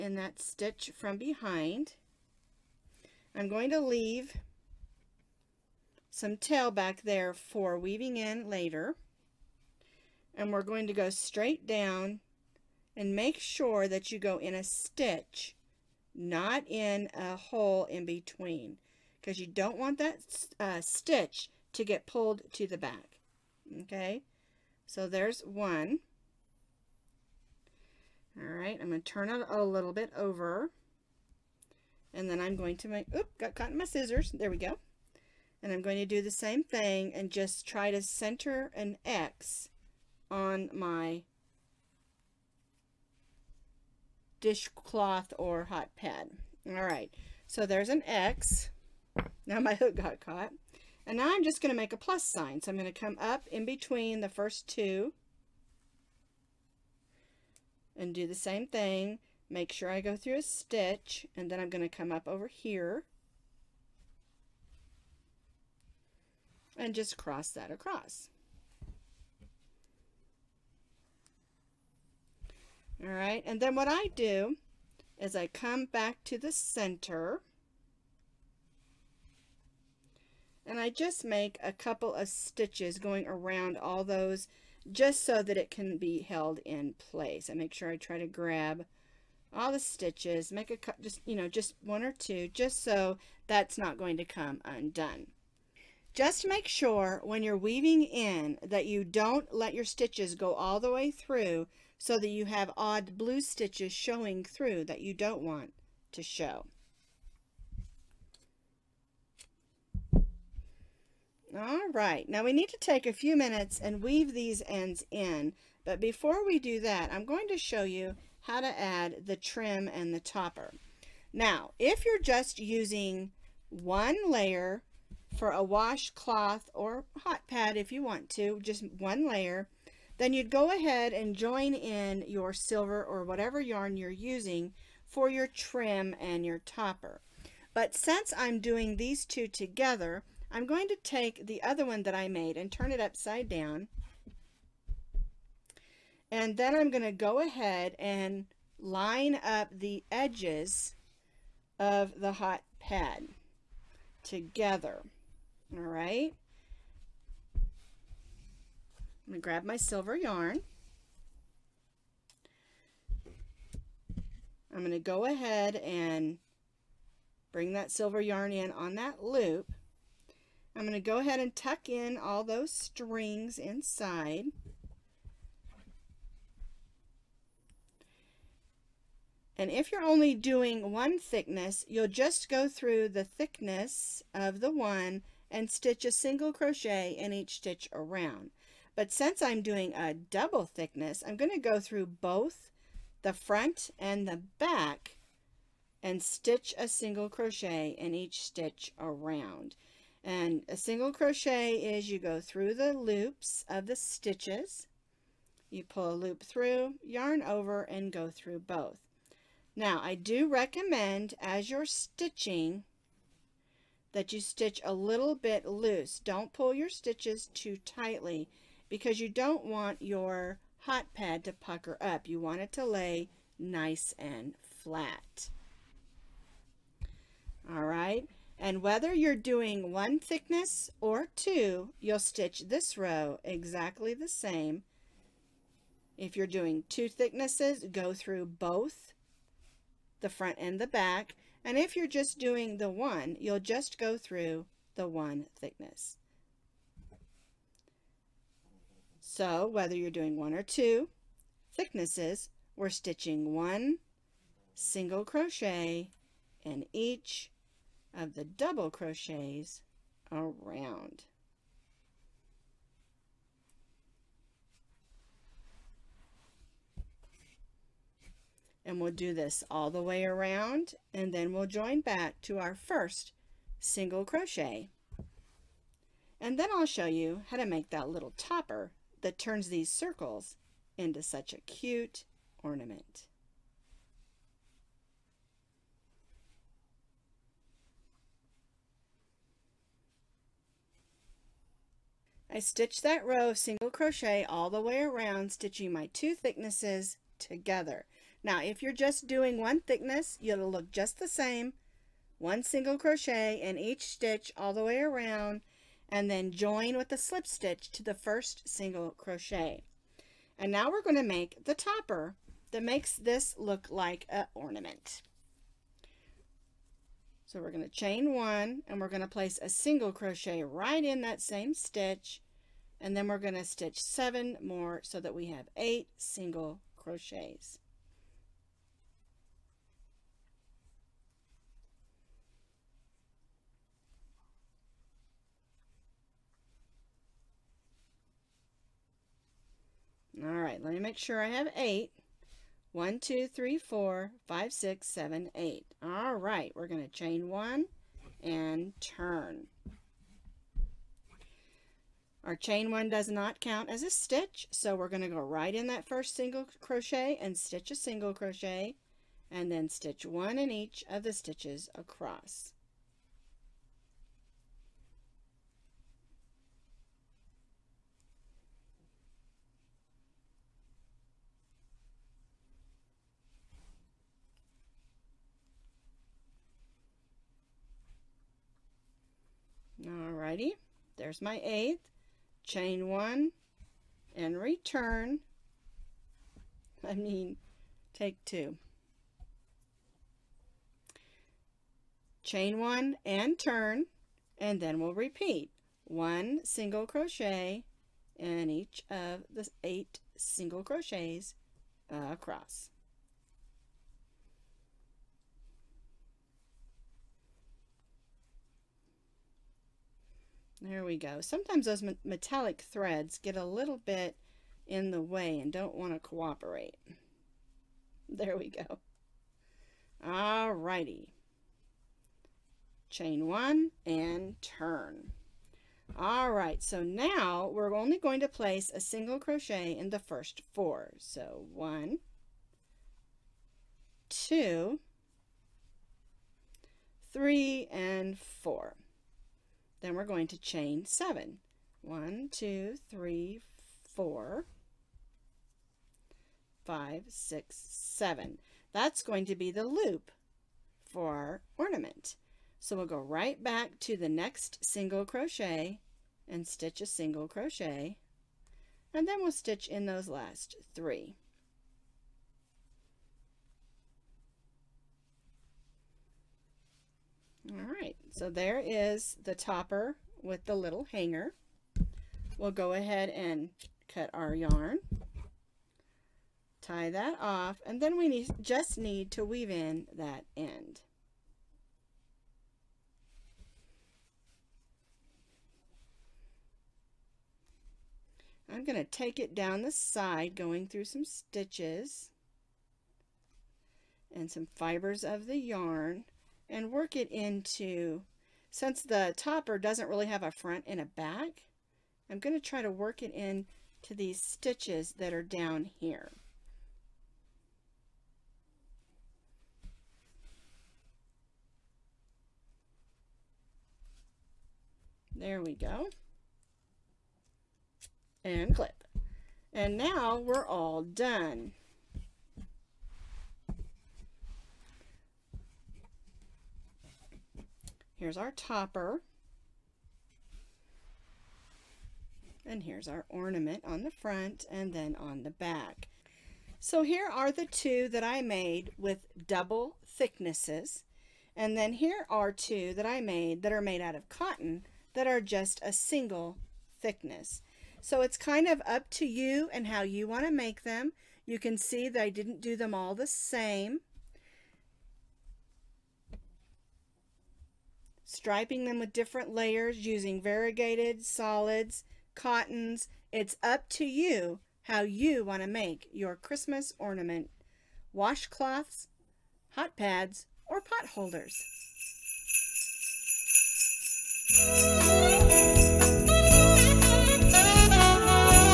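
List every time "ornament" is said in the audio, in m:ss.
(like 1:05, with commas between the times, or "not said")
4:42, 5:14, 7:31, 8:53, 9:26.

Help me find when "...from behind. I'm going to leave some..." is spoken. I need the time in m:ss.
0:00.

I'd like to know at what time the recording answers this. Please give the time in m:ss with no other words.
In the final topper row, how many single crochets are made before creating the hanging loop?
7:10.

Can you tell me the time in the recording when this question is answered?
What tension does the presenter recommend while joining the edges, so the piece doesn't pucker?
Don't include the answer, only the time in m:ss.
3:34.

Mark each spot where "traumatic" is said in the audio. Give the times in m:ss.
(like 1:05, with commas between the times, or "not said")
not said.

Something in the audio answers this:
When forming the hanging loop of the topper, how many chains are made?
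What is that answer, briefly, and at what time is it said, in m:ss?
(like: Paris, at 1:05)
7, at 7:20.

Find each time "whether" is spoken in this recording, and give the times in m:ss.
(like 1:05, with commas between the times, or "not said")
3:48, 4:09.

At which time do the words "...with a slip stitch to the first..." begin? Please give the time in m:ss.
5:06.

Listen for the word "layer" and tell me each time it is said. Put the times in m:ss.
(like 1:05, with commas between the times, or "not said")
2:04, 2:09, 9:19.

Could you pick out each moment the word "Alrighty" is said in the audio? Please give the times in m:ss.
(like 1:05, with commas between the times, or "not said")
6:20, 7:00.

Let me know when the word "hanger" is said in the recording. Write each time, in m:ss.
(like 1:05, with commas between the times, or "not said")
7:51.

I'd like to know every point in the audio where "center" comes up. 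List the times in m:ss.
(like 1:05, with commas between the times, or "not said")
0:38, 1:16.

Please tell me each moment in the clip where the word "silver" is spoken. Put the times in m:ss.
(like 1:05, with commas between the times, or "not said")
2:12, 2:39, 2:47.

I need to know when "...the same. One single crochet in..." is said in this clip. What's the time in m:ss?
5:01.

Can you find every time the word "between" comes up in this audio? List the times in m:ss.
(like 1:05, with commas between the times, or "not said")
0:18, 0:53.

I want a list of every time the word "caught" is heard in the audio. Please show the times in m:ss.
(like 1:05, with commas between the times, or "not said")
0:33, 0:50.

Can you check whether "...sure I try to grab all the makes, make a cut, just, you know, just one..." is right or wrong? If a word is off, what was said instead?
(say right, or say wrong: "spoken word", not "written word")
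wrong: "stitches", not "makes".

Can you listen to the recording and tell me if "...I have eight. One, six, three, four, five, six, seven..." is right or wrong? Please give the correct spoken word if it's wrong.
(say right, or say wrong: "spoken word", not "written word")
wrong: "two", not "six".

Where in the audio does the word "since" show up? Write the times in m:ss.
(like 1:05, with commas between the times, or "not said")
2:17, 3:09, 8:18.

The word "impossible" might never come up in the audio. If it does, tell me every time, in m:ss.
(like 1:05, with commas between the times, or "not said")
not said.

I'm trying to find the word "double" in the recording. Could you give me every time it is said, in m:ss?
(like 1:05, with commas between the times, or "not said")
3:10, 4:18, 8:59.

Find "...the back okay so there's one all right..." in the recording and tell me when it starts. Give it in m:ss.
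0:22.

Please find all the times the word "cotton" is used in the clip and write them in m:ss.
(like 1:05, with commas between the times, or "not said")
9:04, 9:22.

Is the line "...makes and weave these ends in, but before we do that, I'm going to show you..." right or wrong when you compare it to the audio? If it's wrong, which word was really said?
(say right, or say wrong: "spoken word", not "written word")
wrong: "minutes", not "makes".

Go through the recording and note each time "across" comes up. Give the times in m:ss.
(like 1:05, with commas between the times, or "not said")
1:07, 6:01, 6:42.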